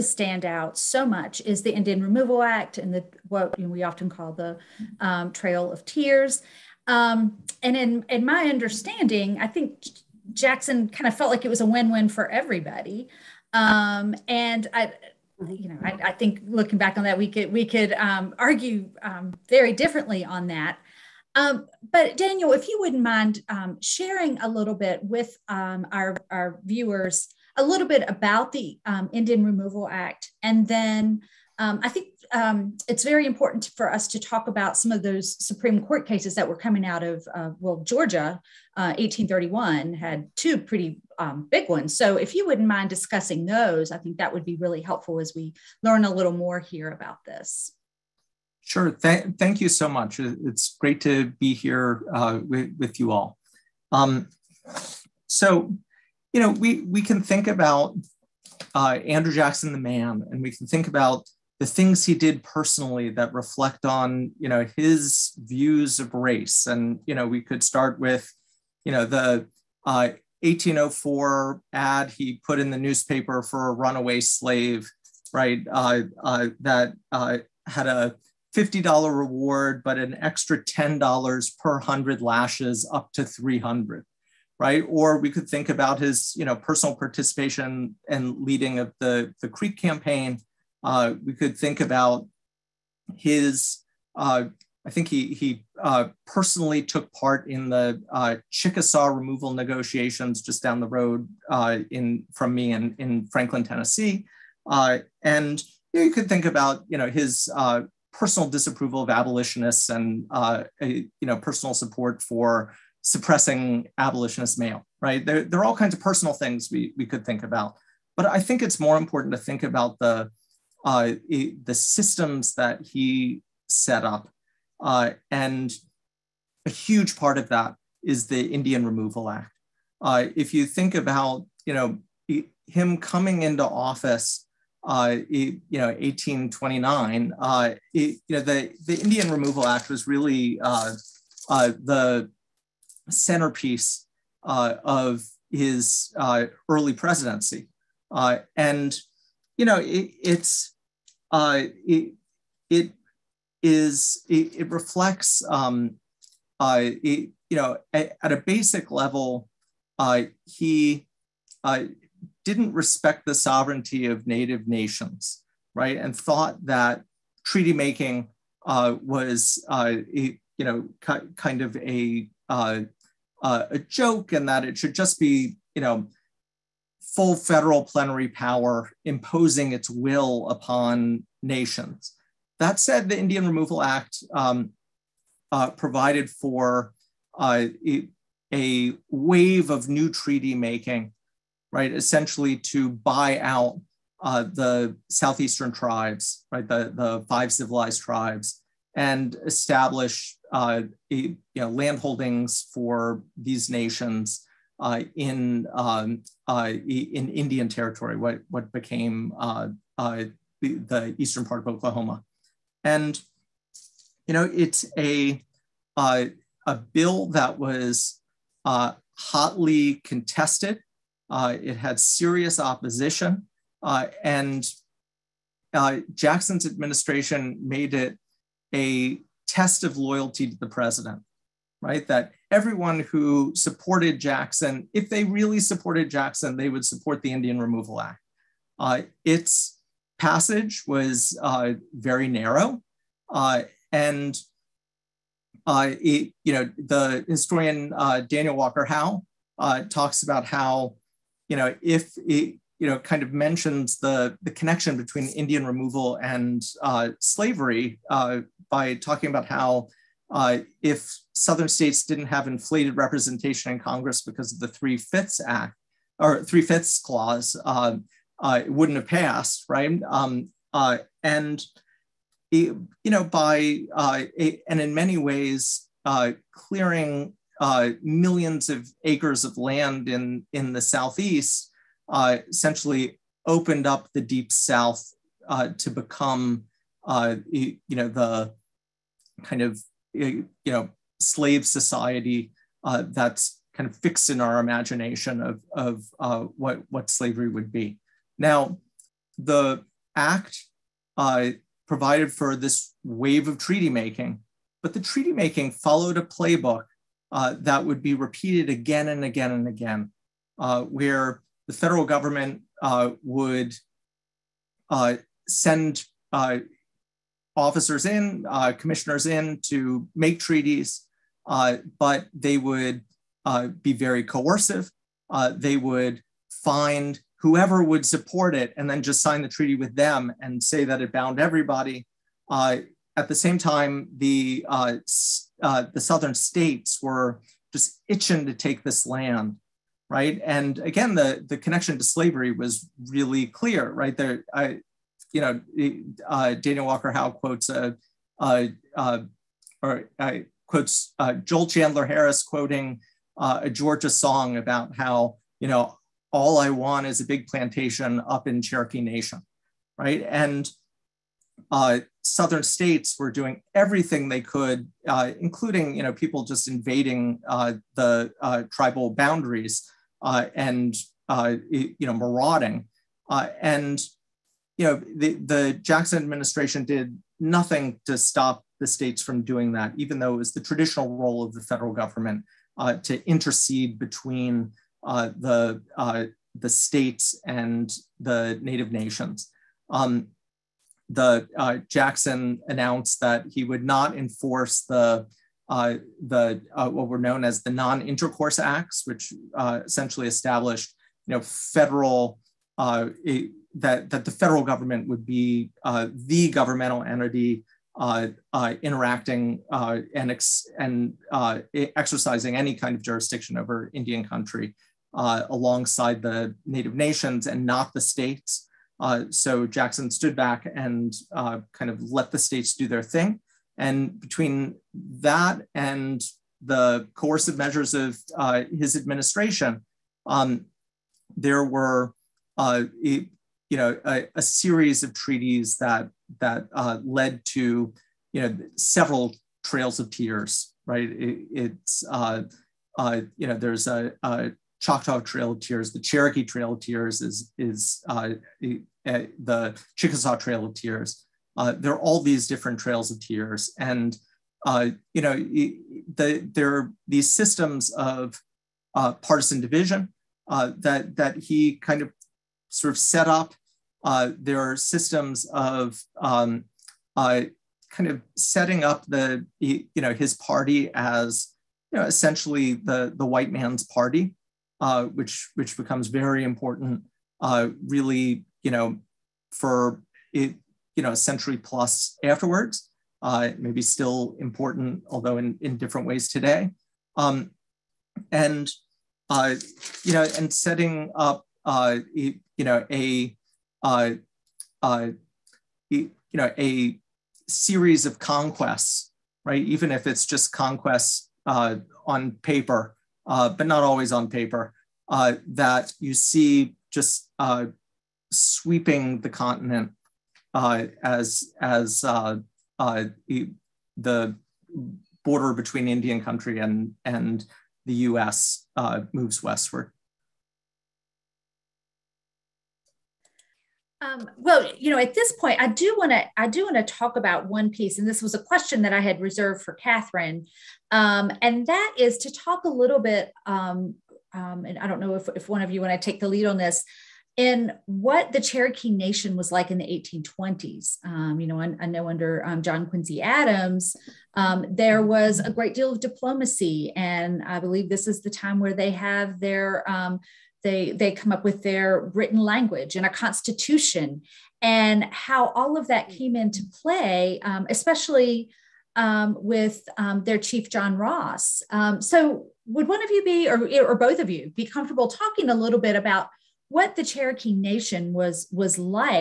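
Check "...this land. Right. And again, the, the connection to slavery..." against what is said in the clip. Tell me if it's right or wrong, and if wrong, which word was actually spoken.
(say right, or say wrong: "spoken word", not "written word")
right.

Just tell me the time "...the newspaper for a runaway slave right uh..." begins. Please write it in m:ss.
1:12.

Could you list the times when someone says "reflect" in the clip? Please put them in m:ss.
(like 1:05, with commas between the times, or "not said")
1:03, 2:34.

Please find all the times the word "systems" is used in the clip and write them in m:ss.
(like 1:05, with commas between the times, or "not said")
2:01, 7:37, 7:44.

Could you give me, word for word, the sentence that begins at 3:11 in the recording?
Essentially to buy out uh, the southeastern tribes, right?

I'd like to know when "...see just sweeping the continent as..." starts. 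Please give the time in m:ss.
8:26.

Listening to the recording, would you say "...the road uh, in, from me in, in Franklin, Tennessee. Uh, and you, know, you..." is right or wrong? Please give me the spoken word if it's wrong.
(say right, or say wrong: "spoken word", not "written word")
right.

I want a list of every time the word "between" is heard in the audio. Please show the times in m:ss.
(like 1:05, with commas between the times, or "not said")
4:14, 6:23, 7:04, 8:35.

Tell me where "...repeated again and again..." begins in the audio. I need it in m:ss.
5:08.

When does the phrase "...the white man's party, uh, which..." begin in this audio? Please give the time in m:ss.
7:53.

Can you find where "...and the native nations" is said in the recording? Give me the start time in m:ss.
6:27.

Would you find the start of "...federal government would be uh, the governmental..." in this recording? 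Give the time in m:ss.
6:44.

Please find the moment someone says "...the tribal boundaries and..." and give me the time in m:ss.
6:07.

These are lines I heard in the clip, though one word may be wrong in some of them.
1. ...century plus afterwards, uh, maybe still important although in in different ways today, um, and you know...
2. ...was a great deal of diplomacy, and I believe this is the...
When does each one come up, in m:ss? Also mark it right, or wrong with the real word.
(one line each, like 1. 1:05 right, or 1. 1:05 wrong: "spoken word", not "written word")
1. 8:01 right
2. 9:05 right.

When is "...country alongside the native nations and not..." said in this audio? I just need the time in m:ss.
6:54.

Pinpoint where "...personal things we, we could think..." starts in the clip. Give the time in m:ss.
1:56.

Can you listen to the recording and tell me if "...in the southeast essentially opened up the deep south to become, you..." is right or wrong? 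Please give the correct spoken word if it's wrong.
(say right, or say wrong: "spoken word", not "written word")
right.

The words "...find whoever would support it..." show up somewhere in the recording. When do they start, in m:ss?
5:26.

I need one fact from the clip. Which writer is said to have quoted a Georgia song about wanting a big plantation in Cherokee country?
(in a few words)
Joel Chandler Harris.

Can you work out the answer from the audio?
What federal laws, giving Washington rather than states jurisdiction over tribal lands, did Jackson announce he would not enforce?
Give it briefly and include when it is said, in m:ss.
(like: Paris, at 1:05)
Non-intercourse acts, at 6:37.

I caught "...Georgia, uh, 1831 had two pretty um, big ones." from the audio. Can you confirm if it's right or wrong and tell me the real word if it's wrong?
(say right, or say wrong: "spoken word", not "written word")
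right.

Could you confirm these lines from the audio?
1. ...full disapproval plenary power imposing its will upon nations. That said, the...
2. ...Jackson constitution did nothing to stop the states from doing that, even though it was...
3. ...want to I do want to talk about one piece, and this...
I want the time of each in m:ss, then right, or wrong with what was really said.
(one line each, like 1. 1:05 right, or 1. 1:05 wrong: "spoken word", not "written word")
1. 2:57 wrong: "federal", not "disapproval"
2. 6:15 wrong: "administration", not "constitution"
3. 8:45 right.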